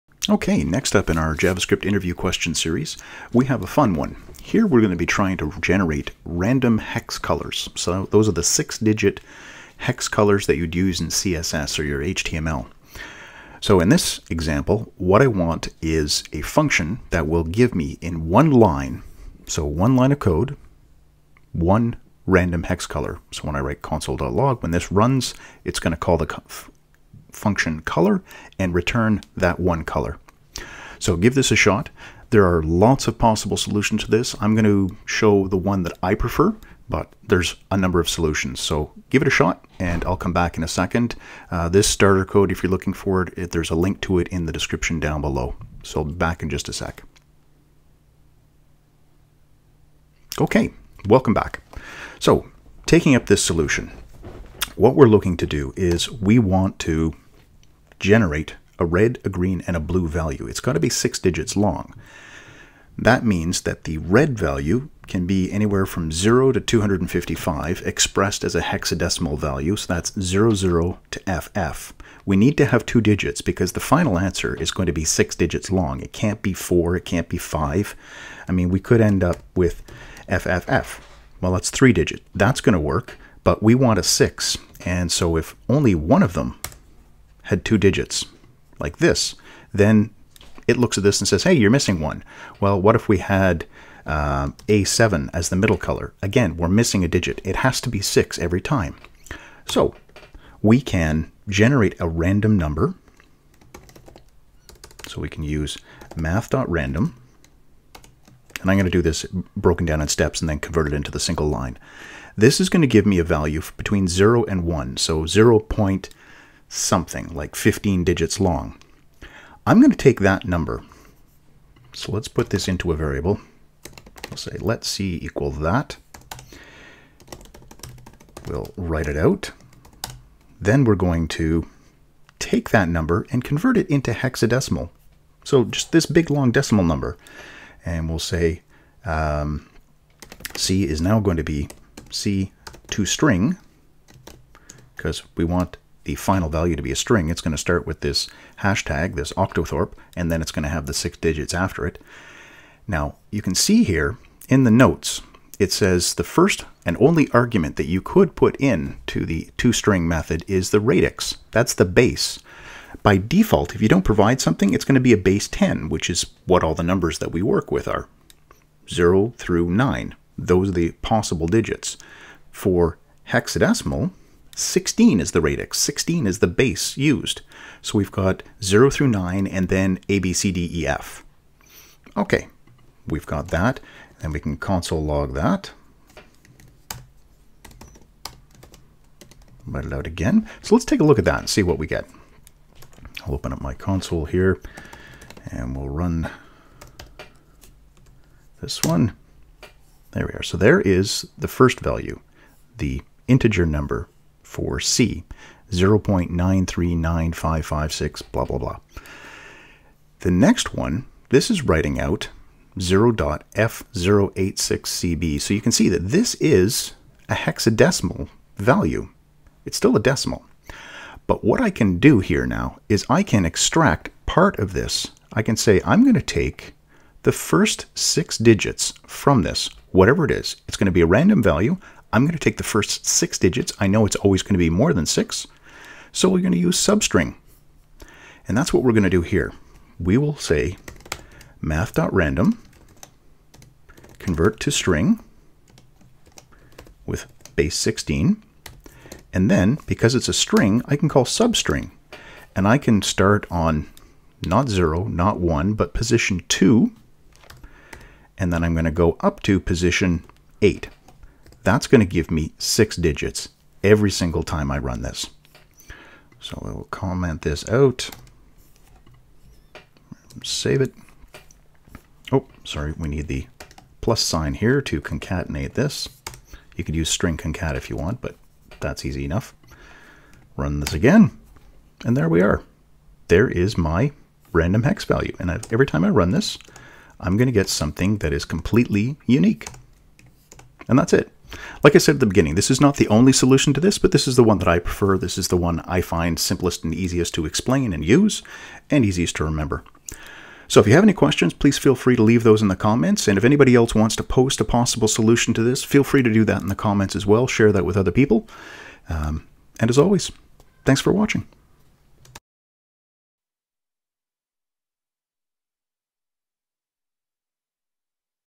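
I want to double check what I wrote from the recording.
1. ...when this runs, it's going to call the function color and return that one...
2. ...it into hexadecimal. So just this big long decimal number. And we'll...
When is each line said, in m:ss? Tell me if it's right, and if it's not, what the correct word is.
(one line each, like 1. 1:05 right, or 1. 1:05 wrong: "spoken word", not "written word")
1. 0:24 right
2. 2:13 right.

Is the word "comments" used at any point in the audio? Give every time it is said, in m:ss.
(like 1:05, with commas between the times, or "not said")
4:26, 5:02, 5:06.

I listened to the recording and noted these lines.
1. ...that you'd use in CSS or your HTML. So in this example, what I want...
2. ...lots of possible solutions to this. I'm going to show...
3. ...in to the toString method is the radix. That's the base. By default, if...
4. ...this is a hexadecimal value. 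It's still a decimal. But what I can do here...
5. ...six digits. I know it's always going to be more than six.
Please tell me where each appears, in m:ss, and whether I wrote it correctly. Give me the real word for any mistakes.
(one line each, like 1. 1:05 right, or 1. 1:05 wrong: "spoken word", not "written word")
1. 0:10 right
2. 0:32 right
3. 2:38 right
4. 3:36 right
5. 3:53 right.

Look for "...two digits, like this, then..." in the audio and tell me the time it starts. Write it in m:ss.
1:27.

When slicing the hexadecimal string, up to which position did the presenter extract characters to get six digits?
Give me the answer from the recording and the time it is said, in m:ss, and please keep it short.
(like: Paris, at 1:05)
8, at 4:19.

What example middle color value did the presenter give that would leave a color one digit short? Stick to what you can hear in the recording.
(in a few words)
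A7.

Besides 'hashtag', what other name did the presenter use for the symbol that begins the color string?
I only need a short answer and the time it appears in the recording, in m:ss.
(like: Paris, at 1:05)
octothorpe, at 2:29.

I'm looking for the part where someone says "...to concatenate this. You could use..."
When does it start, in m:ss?
4:34.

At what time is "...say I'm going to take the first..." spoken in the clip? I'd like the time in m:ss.
3:45.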